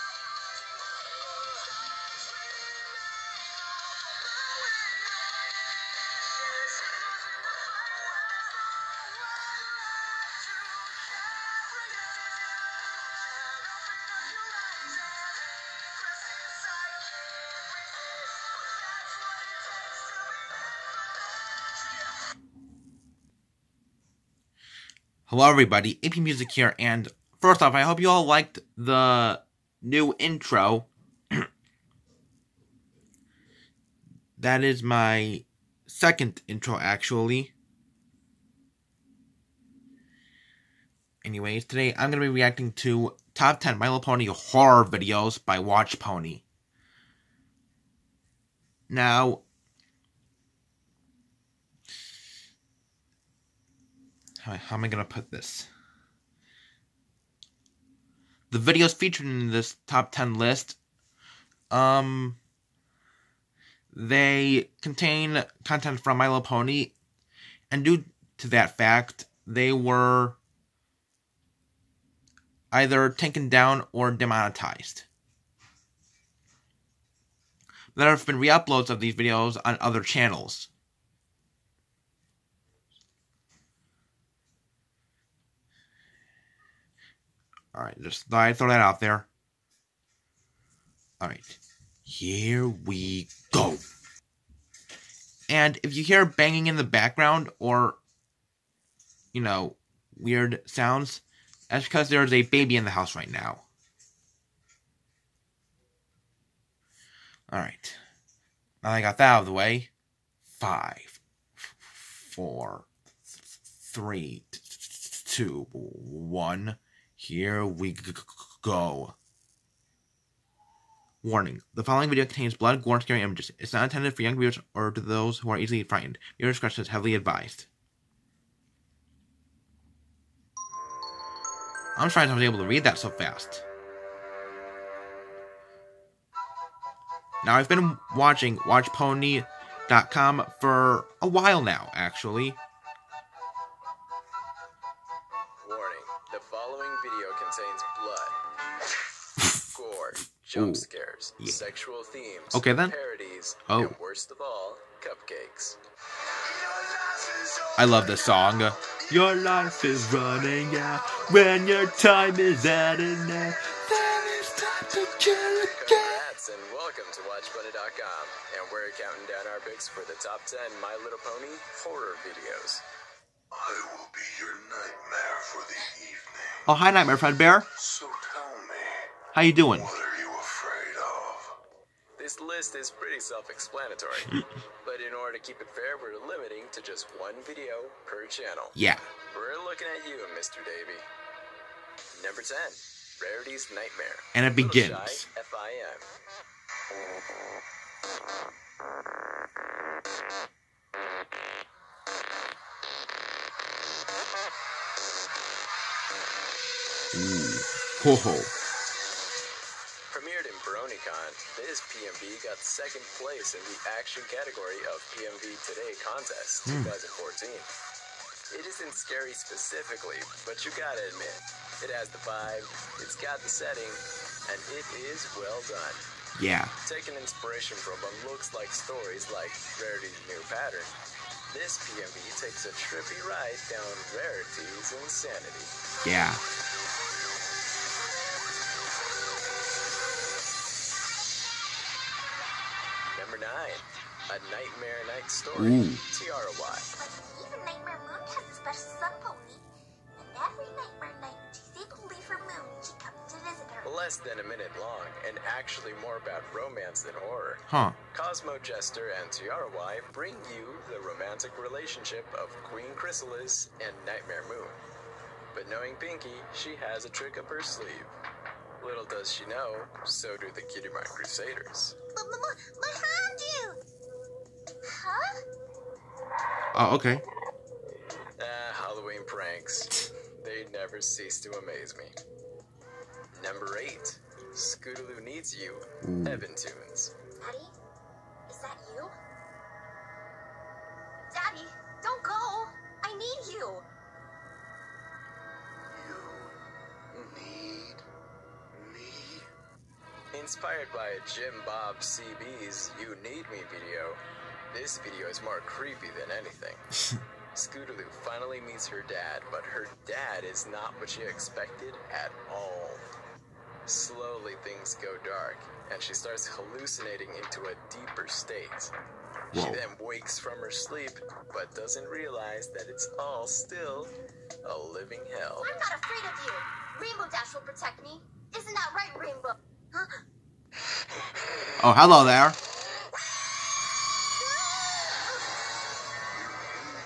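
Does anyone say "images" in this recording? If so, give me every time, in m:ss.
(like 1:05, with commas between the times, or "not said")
2:03.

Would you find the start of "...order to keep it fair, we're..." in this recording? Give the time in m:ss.
3:05.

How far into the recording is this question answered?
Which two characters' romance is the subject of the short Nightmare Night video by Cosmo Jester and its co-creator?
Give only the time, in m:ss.
4:22.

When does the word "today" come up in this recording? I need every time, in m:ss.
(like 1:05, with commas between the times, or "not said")
0:41, 3:35.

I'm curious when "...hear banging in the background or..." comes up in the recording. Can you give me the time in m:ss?
1:36.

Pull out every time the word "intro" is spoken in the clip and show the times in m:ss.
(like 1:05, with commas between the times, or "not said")
0:30, 0:36.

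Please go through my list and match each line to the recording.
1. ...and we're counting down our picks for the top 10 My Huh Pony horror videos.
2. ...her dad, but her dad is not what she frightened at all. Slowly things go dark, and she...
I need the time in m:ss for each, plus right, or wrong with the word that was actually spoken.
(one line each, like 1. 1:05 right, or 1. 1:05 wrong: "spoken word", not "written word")
1. 2:48 wrong: "Little", not "Huh"
2. 5:08 wrong: "expected", not "frightened".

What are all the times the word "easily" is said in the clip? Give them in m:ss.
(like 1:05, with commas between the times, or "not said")
2:05.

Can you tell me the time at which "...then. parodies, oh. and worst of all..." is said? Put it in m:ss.
2:32.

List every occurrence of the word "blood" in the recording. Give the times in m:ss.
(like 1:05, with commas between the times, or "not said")
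2:02.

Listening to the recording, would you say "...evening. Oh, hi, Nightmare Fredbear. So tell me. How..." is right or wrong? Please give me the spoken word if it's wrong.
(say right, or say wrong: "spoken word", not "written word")
right.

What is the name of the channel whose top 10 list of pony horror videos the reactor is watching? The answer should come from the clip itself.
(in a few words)
Watch Pony.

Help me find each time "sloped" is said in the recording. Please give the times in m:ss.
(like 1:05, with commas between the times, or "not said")
not said.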